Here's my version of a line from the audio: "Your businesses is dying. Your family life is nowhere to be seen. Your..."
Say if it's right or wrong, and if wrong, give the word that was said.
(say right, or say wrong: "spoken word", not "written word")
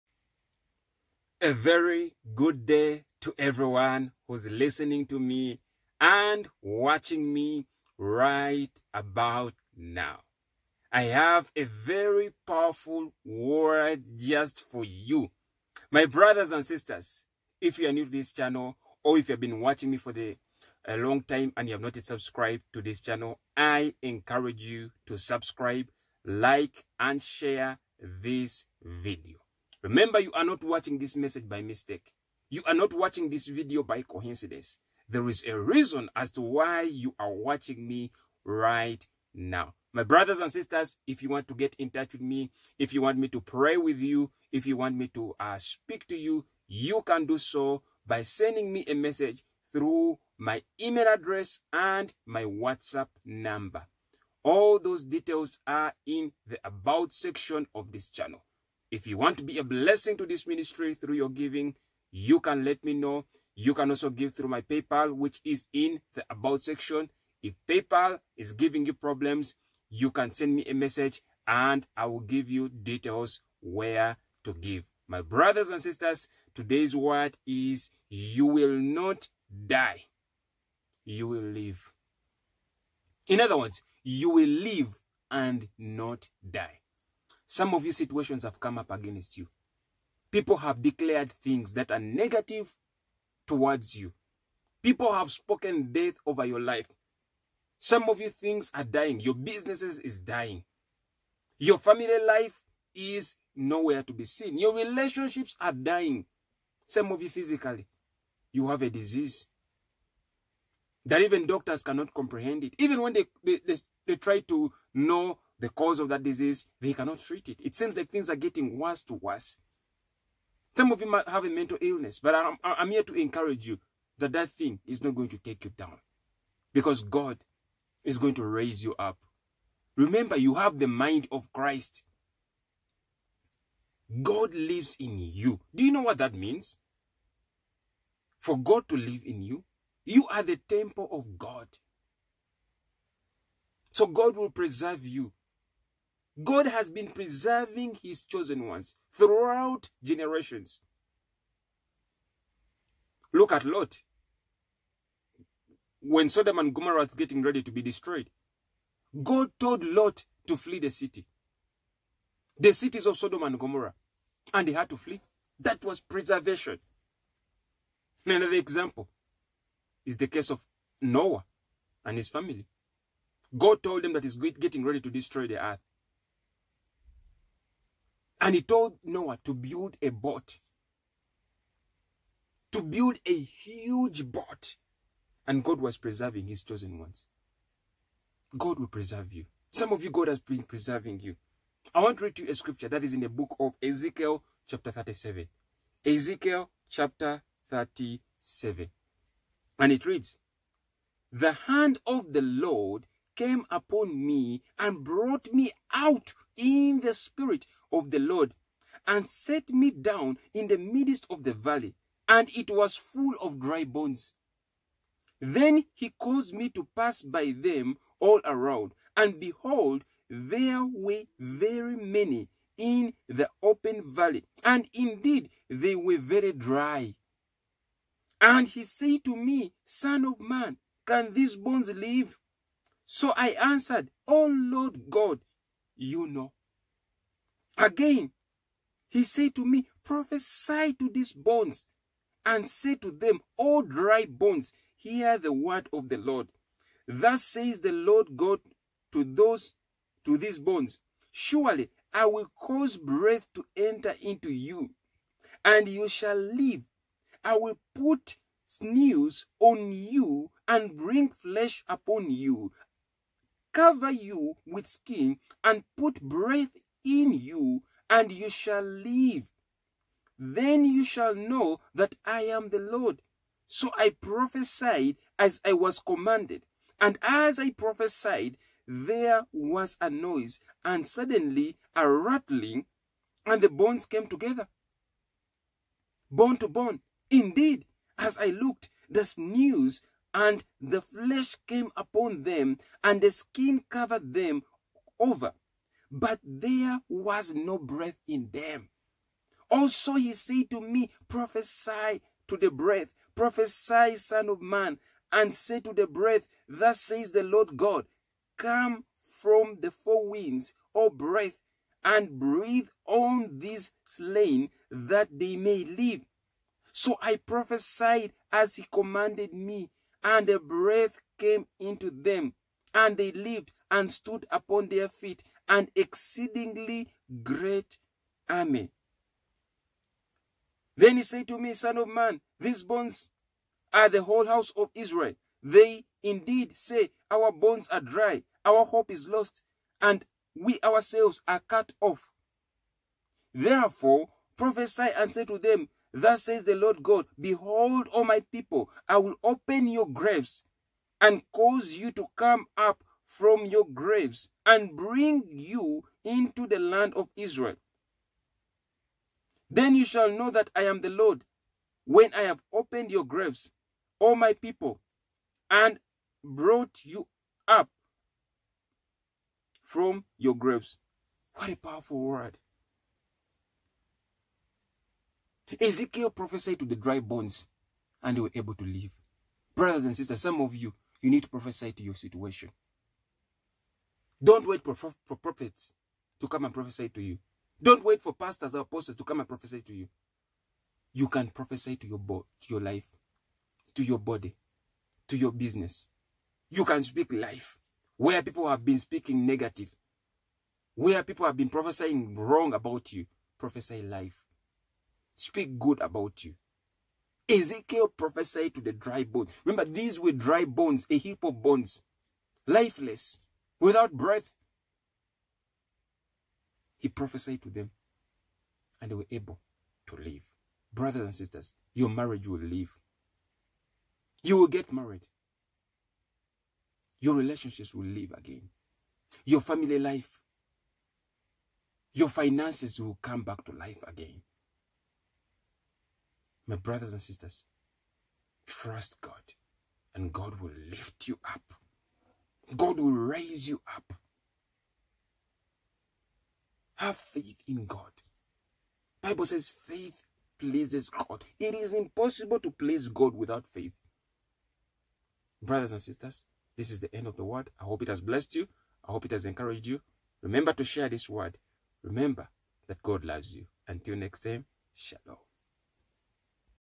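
right.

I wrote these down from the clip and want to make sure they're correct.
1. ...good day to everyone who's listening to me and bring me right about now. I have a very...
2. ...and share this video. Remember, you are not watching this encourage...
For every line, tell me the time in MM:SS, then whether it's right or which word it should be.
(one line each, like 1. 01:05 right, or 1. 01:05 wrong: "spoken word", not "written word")
1. 00:02 wrong: "watching", not "bring"
2. 00:26 wrong: "message", not "encourage".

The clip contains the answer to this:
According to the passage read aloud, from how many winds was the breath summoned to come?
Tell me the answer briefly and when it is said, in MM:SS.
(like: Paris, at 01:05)
4, at 05:09.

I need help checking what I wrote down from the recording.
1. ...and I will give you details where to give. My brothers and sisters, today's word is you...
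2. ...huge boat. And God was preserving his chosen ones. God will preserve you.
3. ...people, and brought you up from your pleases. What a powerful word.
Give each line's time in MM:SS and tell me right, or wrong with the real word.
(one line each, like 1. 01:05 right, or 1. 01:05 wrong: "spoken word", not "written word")
1. 01:11 right
2. 03:03 right
3. 06:04 wrong: "graves", not "pleases".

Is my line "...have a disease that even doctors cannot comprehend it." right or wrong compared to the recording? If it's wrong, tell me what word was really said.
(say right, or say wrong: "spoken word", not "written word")
right.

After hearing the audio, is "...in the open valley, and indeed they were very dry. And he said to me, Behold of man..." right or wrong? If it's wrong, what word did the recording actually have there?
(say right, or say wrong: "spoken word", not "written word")
wrong: "Son", not "Behold".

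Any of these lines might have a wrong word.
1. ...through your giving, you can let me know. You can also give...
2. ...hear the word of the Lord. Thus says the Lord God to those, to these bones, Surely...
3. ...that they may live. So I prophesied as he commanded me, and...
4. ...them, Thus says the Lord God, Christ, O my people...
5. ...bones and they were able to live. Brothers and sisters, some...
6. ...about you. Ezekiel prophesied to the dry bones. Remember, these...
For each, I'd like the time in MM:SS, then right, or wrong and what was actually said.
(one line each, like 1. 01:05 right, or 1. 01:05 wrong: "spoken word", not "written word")
1. 01:00 right
2. 04:04 right
3. 05:14 right
4. 05:45 wrong: "Behold", not "Christ"
5. 06:17 right
6. 06:46 right.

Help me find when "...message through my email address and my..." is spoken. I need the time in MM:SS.
00:48.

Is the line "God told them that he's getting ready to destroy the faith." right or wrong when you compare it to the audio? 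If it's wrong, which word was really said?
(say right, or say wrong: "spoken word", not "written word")
wrong: "earth", not "faith".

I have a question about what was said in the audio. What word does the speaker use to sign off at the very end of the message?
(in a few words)
shalom.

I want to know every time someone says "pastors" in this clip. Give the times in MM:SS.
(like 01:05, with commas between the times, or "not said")
06:28.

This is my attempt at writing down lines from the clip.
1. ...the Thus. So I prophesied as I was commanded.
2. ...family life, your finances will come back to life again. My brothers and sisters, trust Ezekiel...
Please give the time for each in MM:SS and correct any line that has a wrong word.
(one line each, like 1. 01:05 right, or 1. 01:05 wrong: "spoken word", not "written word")
1. 04:32 wrong: "Lord", not "Thus"
2. 07:09 wrong: "God", not "Ezekiel".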